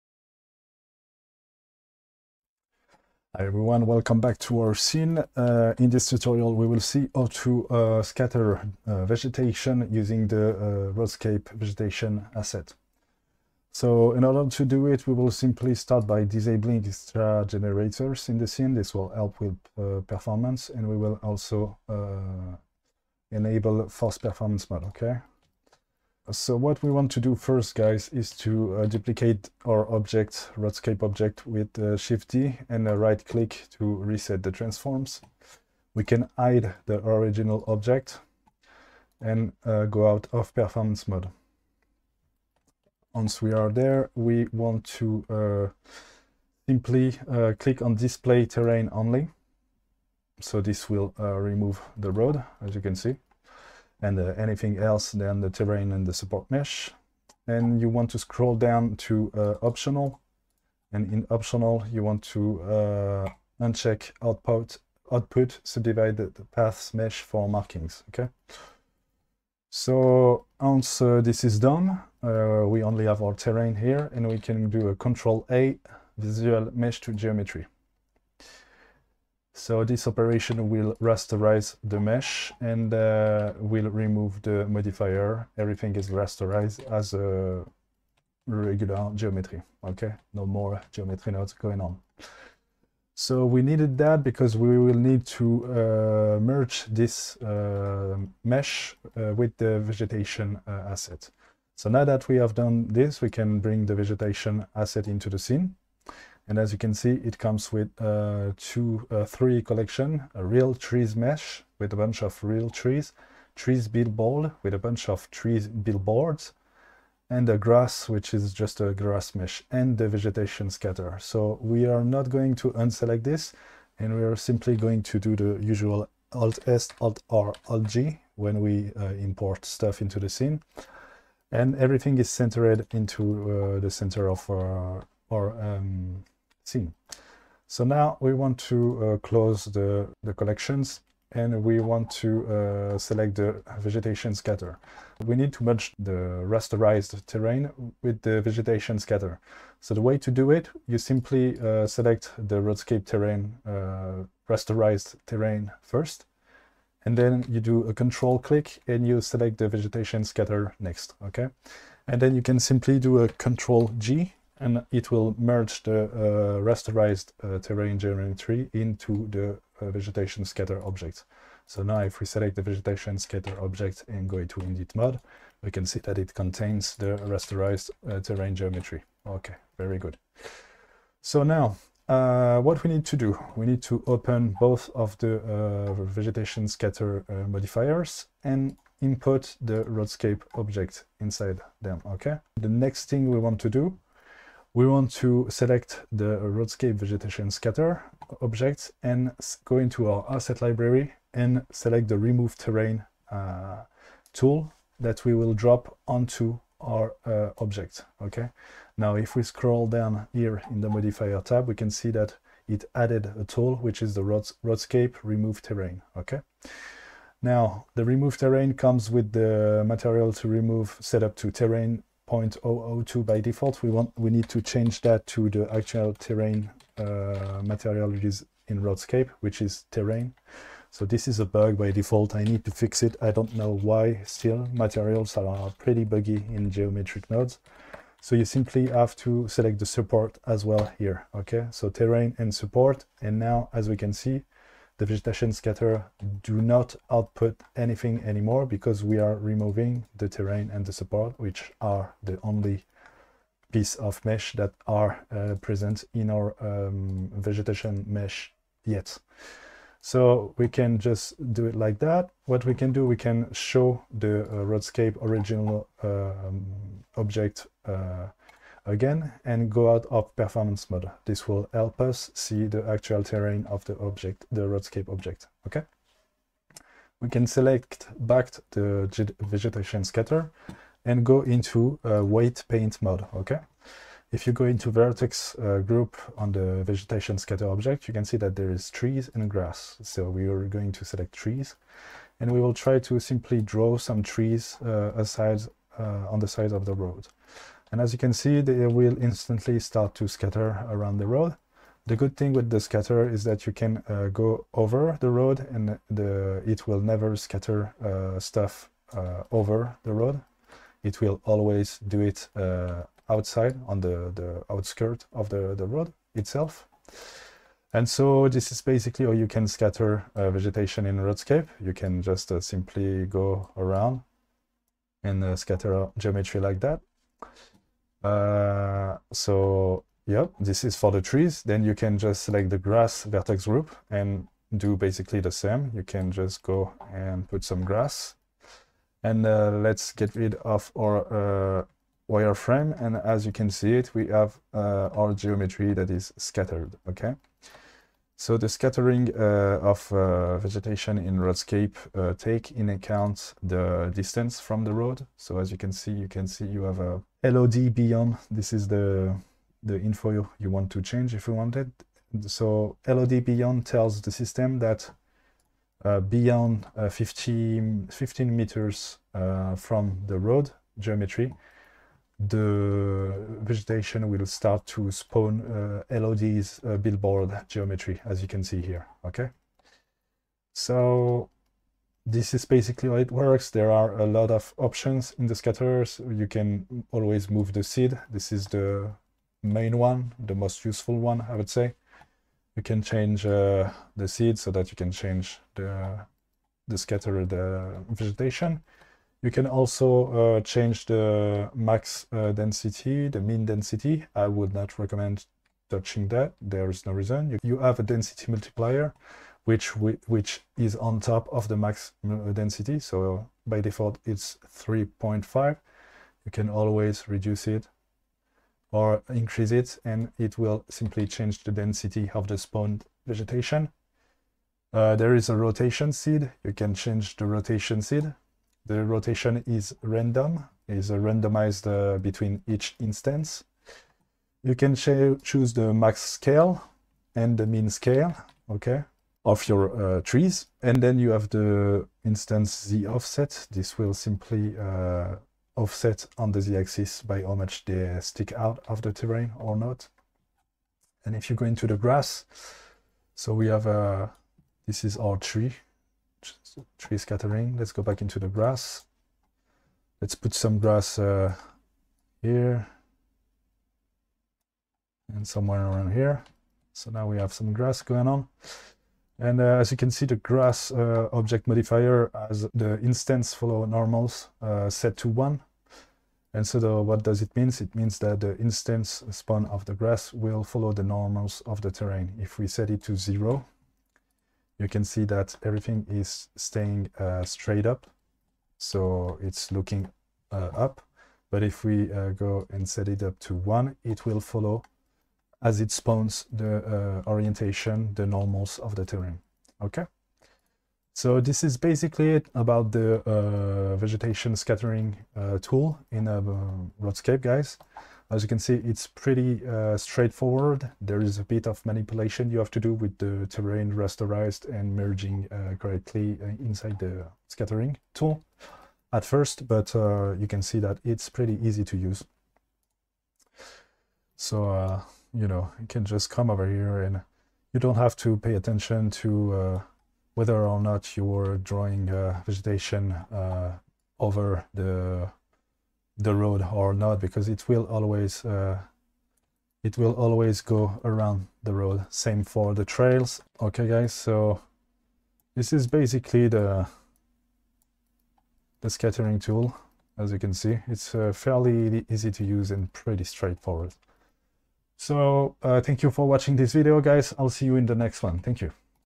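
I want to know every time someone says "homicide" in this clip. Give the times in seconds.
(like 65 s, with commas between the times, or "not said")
not said.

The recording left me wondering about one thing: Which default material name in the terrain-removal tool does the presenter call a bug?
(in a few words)
terrain 0.002.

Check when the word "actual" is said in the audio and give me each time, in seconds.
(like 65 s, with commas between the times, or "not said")
225 s, 272 s.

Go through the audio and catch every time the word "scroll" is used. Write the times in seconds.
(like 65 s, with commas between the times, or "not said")
58 s, 209 s.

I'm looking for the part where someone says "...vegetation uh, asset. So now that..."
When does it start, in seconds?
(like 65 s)
99 s.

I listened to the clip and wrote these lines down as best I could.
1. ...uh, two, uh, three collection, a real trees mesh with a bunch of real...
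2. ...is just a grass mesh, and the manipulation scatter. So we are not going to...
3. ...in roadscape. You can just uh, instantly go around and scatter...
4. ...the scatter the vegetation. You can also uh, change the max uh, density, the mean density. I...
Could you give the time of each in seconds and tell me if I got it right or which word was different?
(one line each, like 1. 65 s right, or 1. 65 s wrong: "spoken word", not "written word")
1. 108 s right
2. 118 s wrong: "vegetation", not "manipulation"
3. 321 s wrong: "simply", not "instantly"
4. 396 s right.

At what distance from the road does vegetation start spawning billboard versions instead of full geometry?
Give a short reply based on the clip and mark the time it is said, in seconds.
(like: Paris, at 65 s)
15 meters, at 368 s.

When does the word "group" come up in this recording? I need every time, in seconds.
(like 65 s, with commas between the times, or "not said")
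285 s, 333 s.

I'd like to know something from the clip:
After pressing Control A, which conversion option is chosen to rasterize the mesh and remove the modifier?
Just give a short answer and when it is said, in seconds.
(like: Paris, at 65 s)
Visual mesh to geometry, at 76 s.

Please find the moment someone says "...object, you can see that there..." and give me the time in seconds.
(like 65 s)
287 s.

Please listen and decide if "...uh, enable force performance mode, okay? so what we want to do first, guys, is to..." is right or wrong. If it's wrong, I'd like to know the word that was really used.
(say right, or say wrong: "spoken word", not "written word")
right.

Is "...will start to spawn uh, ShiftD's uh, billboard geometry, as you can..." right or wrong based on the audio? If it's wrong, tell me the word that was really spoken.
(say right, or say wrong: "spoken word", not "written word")
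wrong: "LOD", not "ShiftD".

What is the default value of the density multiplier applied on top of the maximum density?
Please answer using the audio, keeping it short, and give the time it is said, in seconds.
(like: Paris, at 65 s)
3.5, at 414 s.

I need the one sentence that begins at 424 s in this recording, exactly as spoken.
Uh, there is a rotation seed.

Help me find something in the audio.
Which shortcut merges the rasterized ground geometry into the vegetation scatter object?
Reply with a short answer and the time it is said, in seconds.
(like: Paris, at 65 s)
Control G, at 163 s.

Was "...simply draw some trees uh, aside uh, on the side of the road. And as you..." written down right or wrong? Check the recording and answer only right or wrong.
right.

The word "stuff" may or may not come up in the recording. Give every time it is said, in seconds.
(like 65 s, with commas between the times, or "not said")
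129 s, 308 s.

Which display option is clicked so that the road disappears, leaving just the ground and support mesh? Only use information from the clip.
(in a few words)
Display terrain only.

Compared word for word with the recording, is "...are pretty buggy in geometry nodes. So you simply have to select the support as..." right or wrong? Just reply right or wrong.
right.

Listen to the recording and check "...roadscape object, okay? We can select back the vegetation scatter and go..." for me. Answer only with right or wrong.
right.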